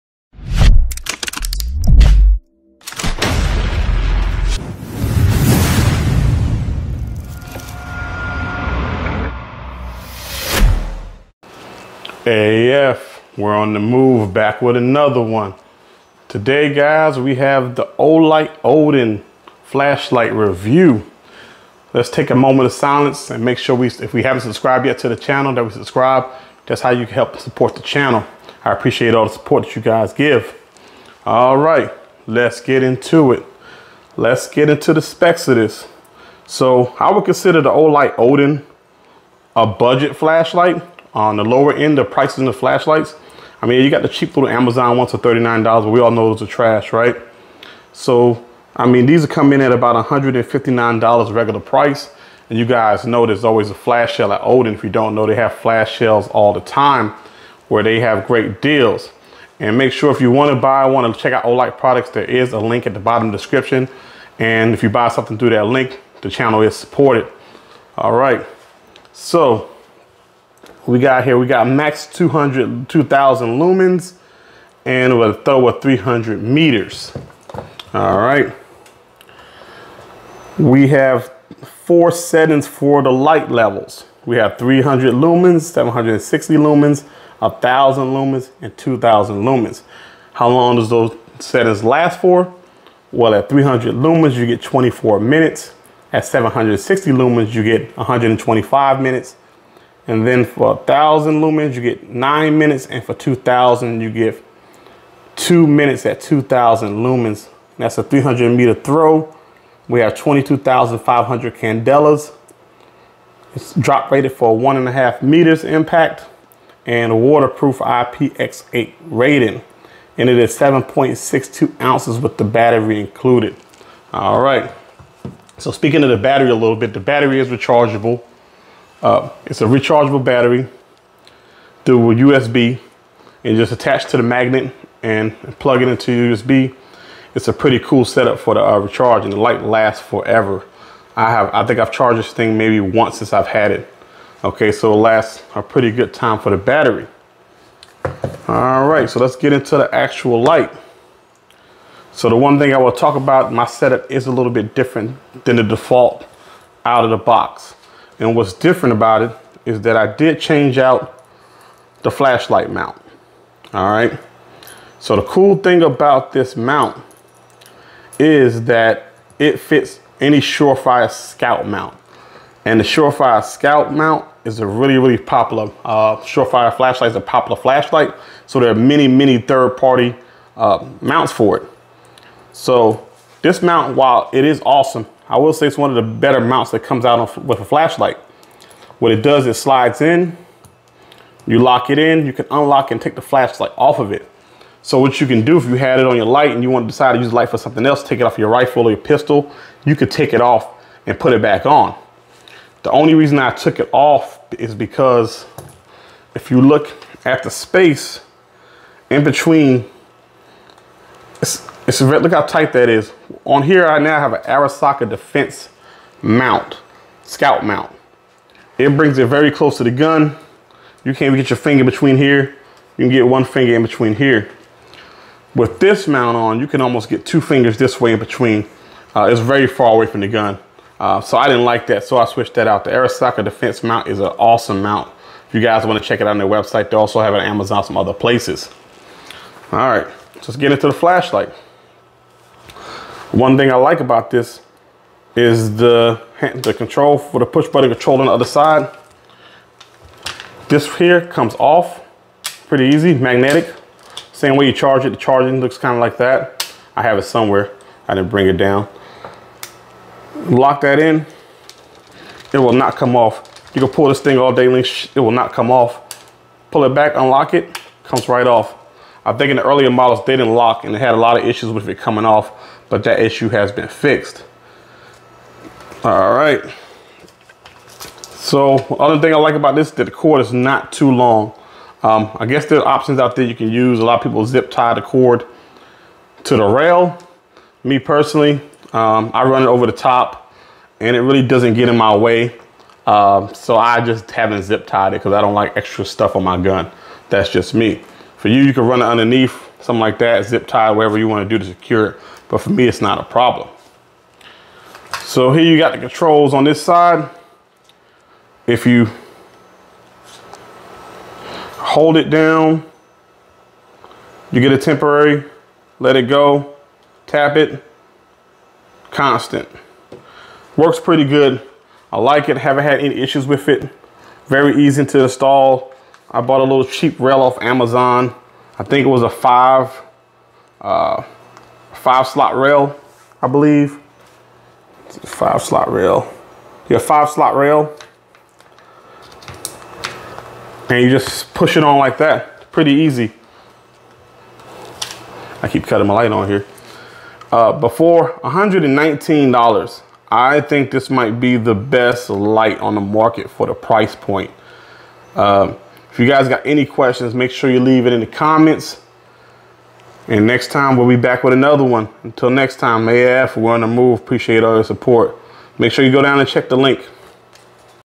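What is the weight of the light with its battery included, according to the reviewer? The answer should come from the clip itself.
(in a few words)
7.62 ounces.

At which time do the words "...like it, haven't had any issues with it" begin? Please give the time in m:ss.
5:22.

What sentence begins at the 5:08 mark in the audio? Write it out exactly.
If you hold it down, you get a temporary, let it go, tap it, constant.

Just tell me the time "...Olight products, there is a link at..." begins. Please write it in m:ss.
1:01.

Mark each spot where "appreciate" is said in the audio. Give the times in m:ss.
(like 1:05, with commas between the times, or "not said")
0:28, 6:04.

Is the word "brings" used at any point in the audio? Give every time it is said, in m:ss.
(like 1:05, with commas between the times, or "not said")
3:38, 4:18.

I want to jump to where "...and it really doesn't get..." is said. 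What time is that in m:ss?
4:50.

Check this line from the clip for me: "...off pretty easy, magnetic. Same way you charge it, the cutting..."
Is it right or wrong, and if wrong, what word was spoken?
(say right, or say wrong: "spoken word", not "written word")
wrong: "charging", not "cutting".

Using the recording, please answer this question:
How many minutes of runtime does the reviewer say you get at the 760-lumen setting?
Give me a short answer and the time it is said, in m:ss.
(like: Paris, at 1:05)
125 minutes, at 1:37.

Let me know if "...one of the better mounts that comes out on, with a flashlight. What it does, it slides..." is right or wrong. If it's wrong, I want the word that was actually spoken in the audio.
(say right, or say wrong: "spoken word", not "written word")
right.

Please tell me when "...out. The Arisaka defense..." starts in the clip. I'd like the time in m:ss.
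3:52.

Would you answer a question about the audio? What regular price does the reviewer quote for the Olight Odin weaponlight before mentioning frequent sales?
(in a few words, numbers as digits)
$159.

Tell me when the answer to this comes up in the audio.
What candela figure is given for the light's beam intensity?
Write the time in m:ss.
1:50.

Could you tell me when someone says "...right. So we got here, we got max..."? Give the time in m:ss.
1:08.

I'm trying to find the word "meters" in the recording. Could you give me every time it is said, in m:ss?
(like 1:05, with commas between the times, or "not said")
1:16, 1:48, 1:55.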